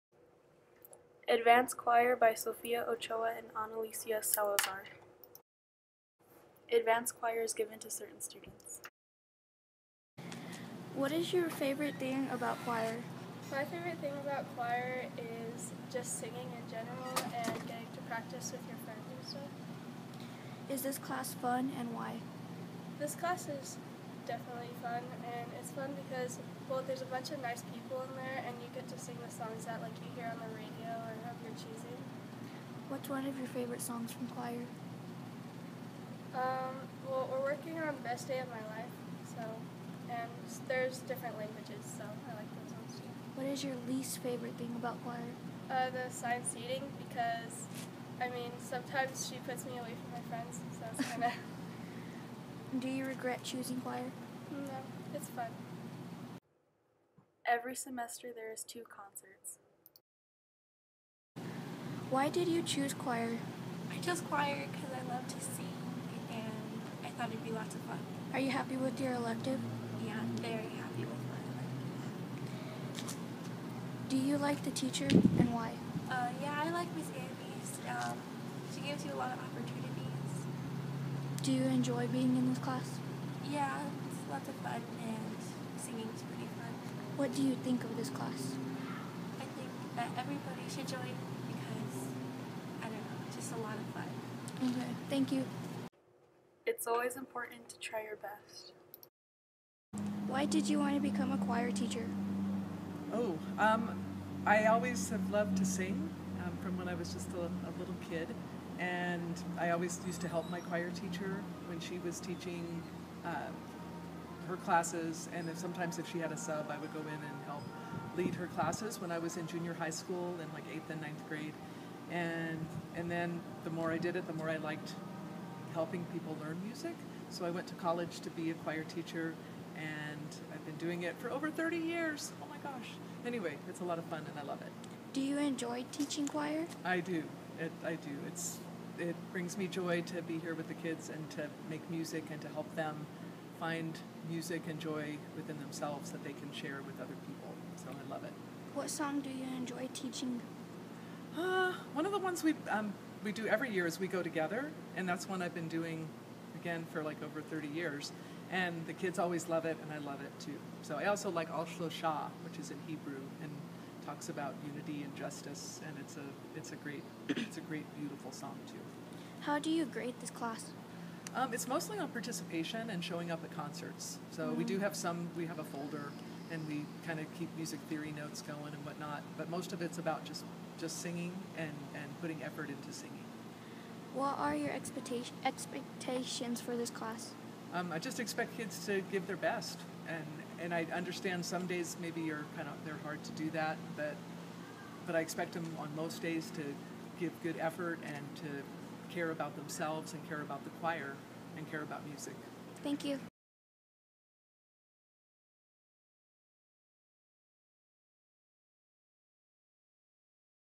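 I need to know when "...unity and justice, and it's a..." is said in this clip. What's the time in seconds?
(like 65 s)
164 s.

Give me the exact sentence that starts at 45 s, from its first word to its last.
Uh, the assigned seating, because, I mean, sometimes she puts me away from my friends, so it's kind of...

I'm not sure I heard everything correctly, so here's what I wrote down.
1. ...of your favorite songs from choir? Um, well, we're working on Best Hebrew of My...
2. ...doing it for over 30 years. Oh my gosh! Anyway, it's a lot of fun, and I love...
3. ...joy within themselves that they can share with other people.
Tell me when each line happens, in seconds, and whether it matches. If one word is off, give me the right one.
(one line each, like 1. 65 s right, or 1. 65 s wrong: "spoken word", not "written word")
1. 33 s wrong: "Day", not "Hebrew"
2. 130 s right
3. 144 s right.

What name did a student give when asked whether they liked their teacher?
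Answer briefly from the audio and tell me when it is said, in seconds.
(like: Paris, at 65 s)
Miss Andy's, at 76 s.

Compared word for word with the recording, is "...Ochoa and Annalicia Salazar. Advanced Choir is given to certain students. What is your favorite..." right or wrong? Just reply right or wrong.
right.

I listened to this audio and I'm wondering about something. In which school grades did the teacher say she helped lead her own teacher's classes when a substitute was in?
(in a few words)
Eighth and ninth grade.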